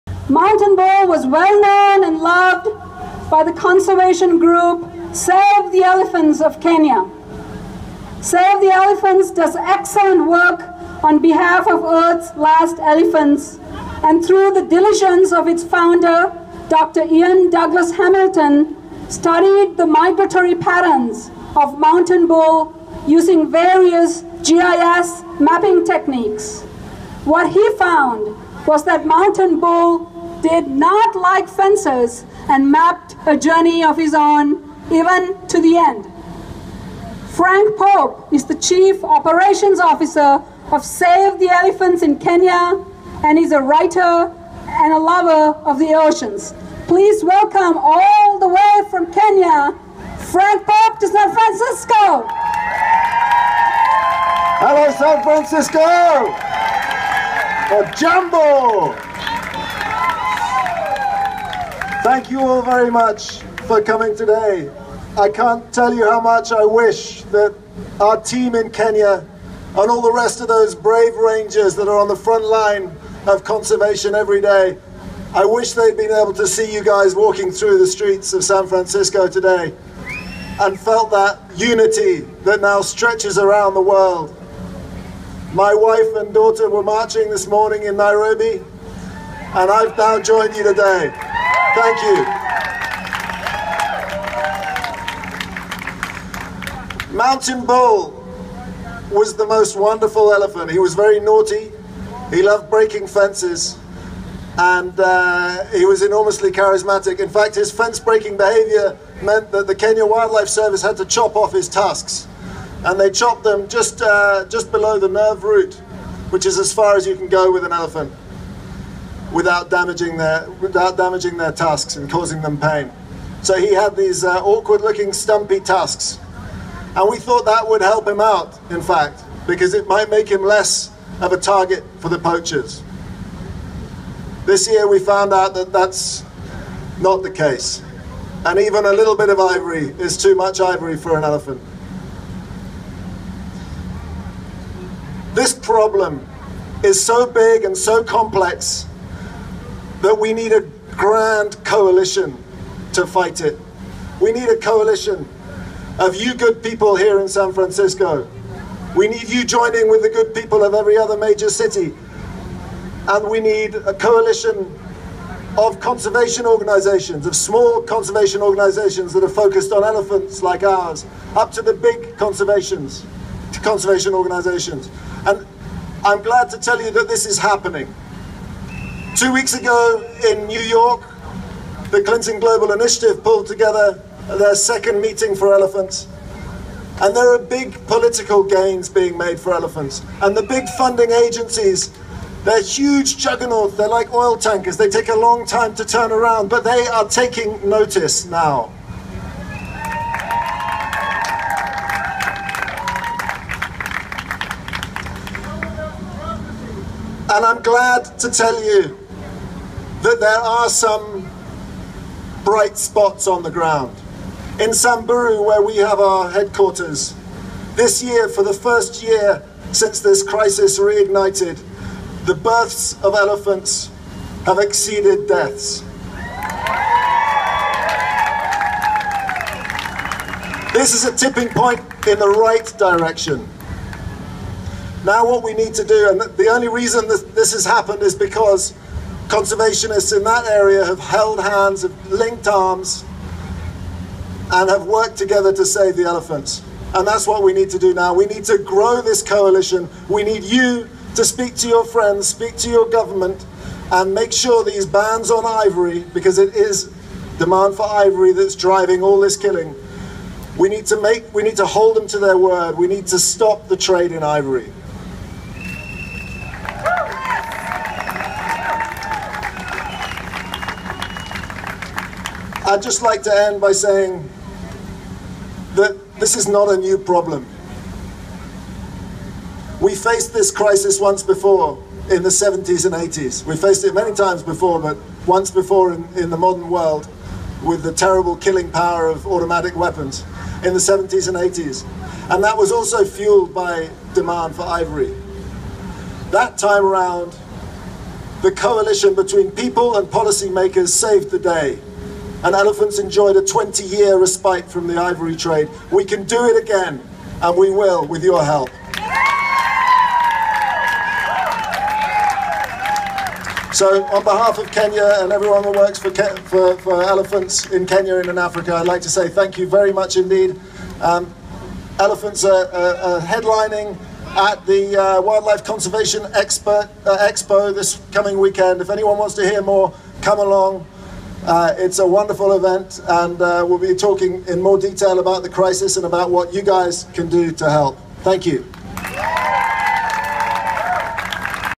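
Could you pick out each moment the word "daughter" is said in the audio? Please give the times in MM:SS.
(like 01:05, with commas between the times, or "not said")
01:26.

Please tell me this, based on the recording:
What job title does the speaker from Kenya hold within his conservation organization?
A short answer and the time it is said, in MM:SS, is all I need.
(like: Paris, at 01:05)
Chief operations officer, at 00:38.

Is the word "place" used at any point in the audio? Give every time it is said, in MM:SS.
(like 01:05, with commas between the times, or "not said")
not said.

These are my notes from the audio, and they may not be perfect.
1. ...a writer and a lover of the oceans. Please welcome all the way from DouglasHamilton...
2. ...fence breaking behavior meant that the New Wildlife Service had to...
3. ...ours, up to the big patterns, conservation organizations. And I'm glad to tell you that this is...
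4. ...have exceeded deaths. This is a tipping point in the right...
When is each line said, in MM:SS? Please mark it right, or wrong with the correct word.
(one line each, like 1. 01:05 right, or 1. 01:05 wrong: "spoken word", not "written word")
1. 00:43 wrong: "Kenya", not "DouglasHamilton"
2. 01:47 wrong: "Kenya", not "New"
3. 02:50 wrong: "conservations", not "patterns"
4. 03:44 right.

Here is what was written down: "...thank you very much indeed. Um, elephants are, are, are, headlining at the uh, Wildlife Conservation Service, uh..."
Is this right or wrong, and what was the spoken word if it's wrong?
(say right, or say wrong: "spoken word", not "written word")
wrong: "Expert", not "Service".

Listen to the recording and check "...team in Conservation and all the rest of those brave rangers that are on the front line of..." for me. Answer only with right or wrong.
wrong.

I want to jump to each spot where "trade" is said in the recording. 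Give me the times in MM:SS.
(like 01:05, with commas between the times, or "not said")
04:23, 05:05.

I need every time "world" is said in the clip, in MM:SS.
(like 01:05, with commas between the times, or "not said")
01:23, 04:46.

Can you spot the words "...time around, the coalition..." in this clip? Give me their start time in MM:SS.
04:56.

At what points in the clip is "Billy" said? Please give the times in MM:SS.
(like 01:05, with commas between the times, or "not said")
not said.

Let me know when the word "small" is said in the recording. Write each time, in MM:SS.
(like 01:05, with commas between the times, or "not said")
02:47.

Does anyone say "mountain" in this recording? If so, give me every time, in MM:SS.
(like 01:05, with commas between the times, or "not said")
00:00, 00:21, 00:29, 01:37.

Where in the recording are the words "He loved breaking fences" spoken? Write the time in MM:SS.
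01:42.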